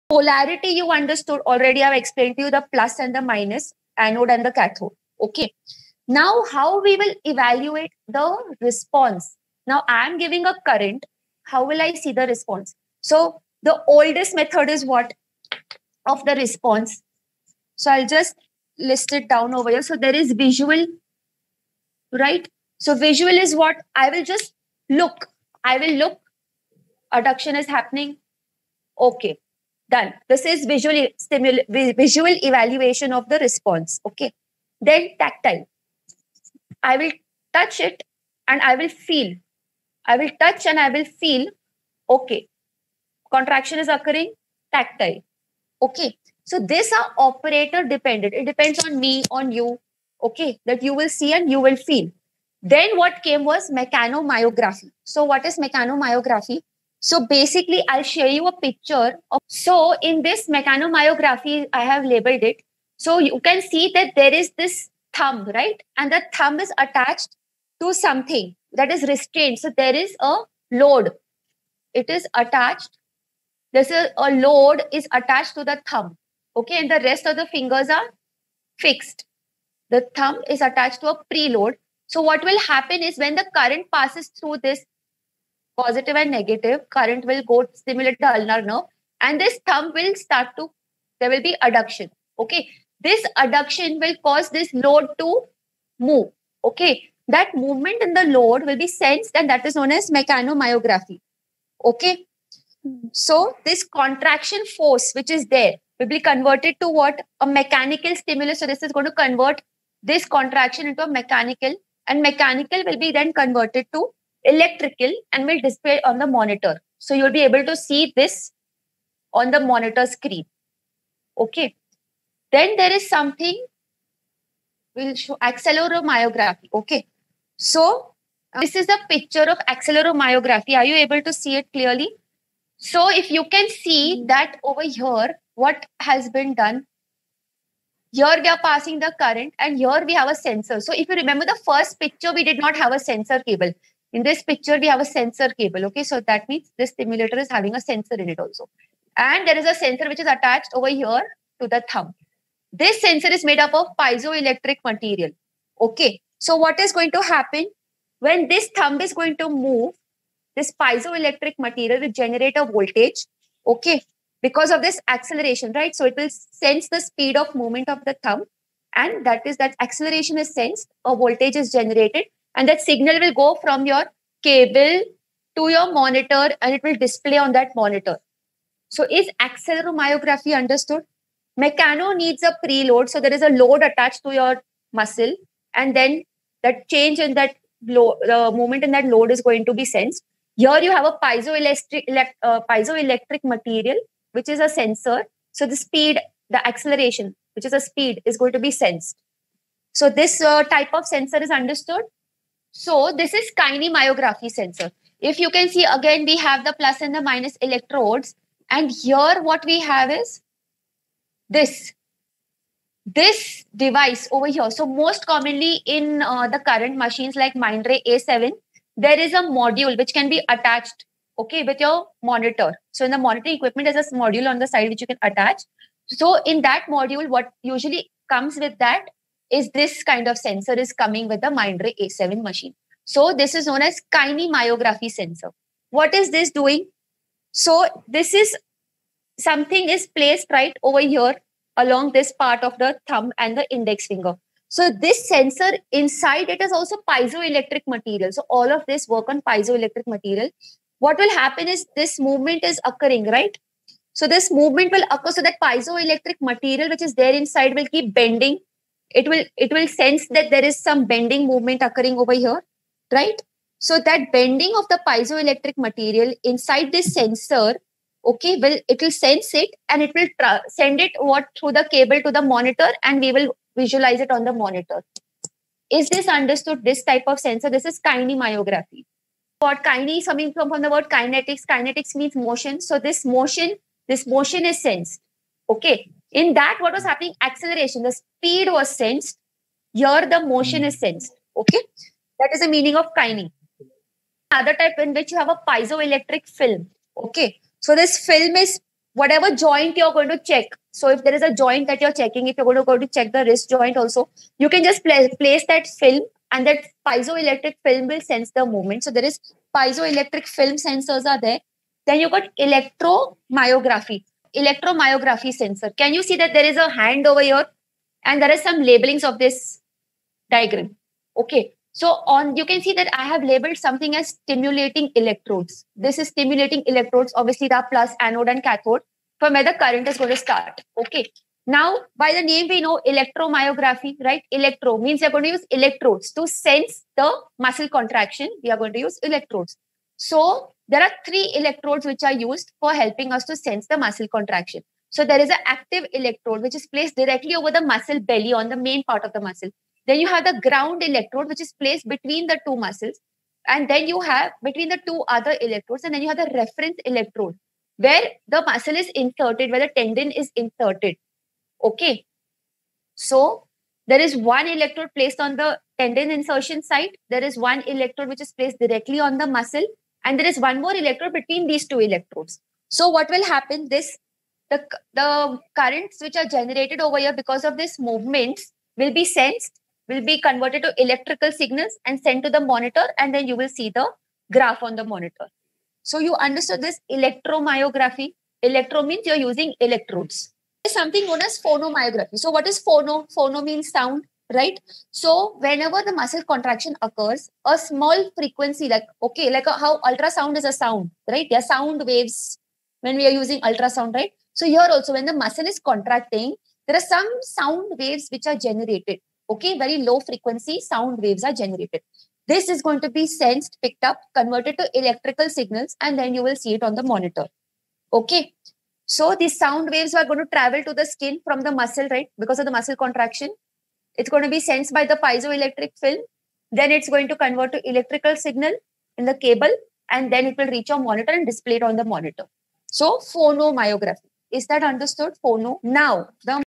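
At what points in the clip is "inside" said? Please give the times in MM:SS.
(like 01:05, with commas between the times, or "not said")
04:05, 04:17, 04:26.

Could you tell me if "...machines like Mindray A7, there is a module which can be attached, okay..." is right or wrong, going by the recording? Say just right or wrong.
right.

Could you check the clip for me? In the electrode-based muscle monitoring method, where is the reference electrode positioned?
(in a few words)
Tendon insertion site.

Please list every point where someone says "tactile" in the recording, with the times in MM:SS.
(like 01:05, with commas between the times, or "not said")
00:35, 00:44.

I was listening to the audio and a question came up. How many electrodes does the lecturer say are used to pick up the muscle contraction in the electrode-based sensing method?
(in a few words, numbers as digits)
3.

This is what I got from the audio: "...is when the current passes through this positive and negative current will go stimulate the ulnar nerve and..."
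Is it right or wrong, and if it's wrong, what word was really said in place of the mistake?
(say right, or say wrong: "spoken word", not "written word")
right.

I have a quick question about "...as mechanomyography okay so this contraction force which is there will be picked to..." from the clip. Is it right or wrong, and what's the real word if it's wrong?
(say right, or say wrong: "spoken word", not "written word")
wrong: "converted", not "picked".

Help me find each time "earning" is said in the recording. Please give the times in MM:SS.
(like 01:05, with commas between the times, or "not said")
not said.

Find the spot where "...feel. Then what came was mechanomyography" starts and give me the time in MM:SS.
00:51.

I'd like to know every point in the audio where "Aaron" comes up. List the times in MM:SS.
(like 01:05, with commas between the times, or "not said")
not said.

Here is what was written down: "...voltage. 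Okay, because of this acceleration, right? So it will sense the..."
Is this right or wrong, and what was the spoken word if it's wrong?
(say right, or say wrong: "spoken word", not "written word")
right.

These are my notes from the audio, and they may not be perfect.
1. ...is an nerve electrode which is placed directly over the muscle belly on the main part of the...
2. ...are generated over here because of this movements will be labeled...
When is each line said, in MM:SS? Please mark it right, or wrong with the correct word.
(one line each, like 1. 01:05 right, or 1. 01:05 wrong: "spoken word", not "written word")
1. 05:45 wrong: "active", not "nerve"
2. 06:16 wrong: "sensed", not "labeled".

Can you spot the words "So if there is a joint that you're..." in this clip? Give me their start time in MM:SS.
05:00.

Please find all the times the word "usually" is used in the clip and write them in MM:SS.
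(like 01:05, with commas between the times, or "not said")
03:47.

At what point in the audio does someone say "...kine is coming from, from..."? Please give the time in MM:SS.
04:39.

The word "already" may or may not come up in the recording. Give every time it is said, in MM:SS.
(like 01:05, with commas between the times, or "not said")
00:01.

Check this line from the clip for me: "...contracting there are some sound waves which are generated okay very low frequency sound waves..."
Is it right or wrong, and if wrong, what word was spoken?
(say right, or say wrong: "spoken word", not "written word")
right.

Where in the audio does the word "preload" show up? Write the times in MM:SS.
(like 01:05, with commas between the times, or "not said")
01:21, 03:02.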